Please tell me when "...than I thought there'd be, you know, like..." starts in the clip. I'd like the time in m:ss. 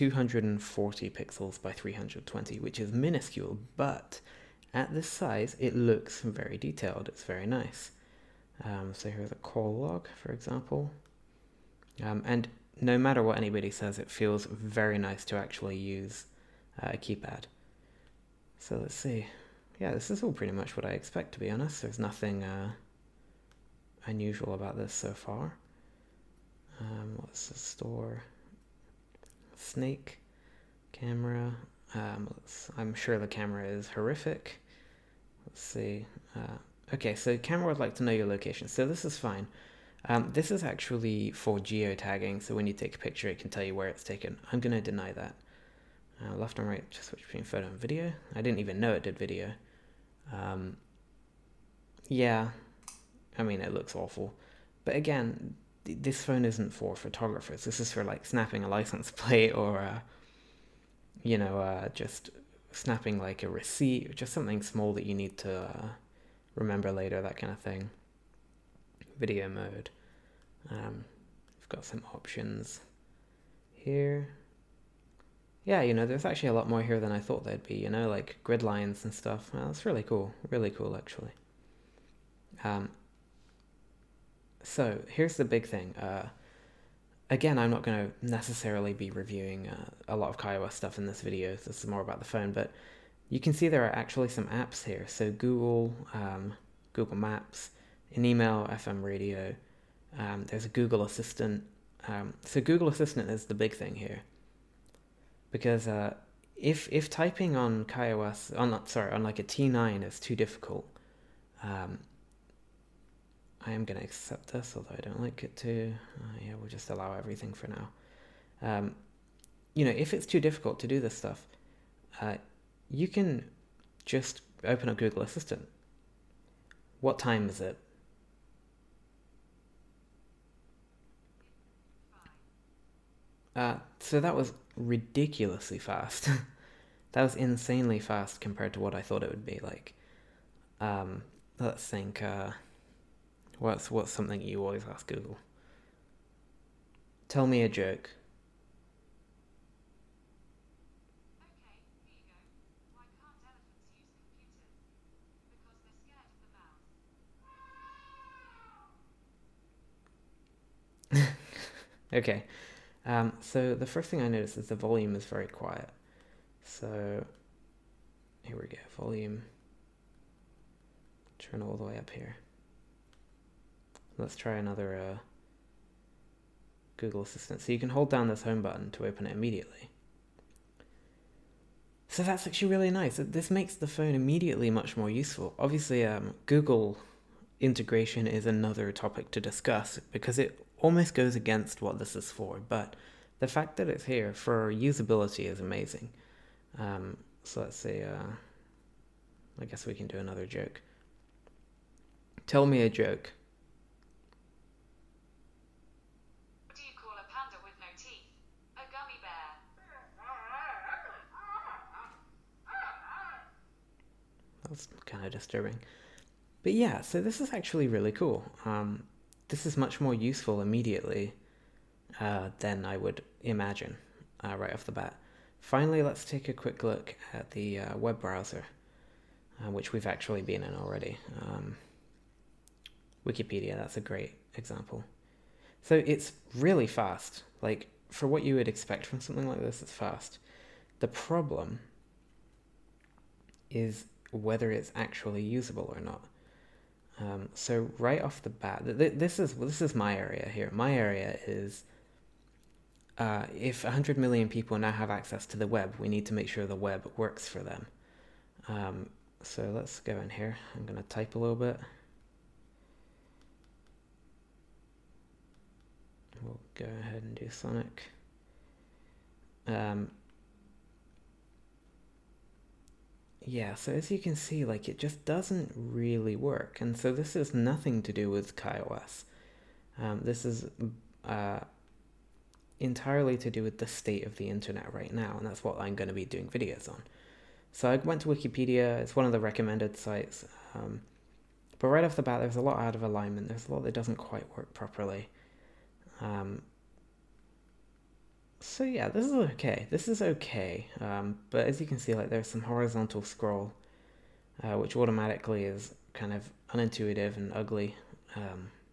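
1:16.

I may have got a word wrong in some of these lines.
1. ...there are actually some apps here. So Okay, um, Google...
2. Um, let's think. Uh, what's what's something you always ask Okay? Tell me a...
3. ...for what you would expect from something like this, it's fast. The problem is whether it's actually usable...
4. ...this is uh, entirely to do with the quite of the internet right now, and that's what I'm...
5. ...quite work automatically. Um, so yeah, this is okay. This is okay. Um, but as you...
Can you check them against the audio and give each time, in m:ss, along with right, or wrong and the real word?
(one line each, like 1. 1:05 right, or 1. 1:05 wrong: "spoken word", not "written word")
1. 1:33 wrong: "Google", not "Okay"
2. 2:20 wrong: "Google", not "Okay"
3. 3:58 right
4. 4:40 wrong: "state", not "quite"
5. 4:54 wrong: "properly", not "automatically".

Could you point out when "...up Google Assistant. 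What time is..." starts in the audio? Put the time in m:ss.
2:04.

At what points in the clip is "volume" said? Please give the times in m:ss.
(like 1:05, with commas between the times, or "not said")
2:44, 2:49.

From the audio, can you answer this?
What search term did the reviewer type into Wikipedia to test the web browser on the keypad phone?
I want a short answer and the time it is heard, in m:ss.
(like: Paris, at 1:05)
Sonic, at 4:27.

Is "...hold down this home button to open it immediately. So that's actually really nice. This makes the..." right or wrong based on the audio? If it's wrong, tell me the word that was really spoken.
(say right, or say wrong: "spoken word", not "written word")
right.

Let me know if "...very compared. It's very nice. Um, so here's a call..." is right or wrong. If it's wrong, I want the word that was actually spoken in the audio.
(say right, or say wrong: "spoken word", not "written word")
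wrong: "detailed", not "compared".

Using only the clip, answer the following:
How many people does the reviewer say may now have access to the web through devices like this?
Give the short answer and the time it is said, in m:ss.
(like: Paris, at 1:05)
100 million, at 4:13.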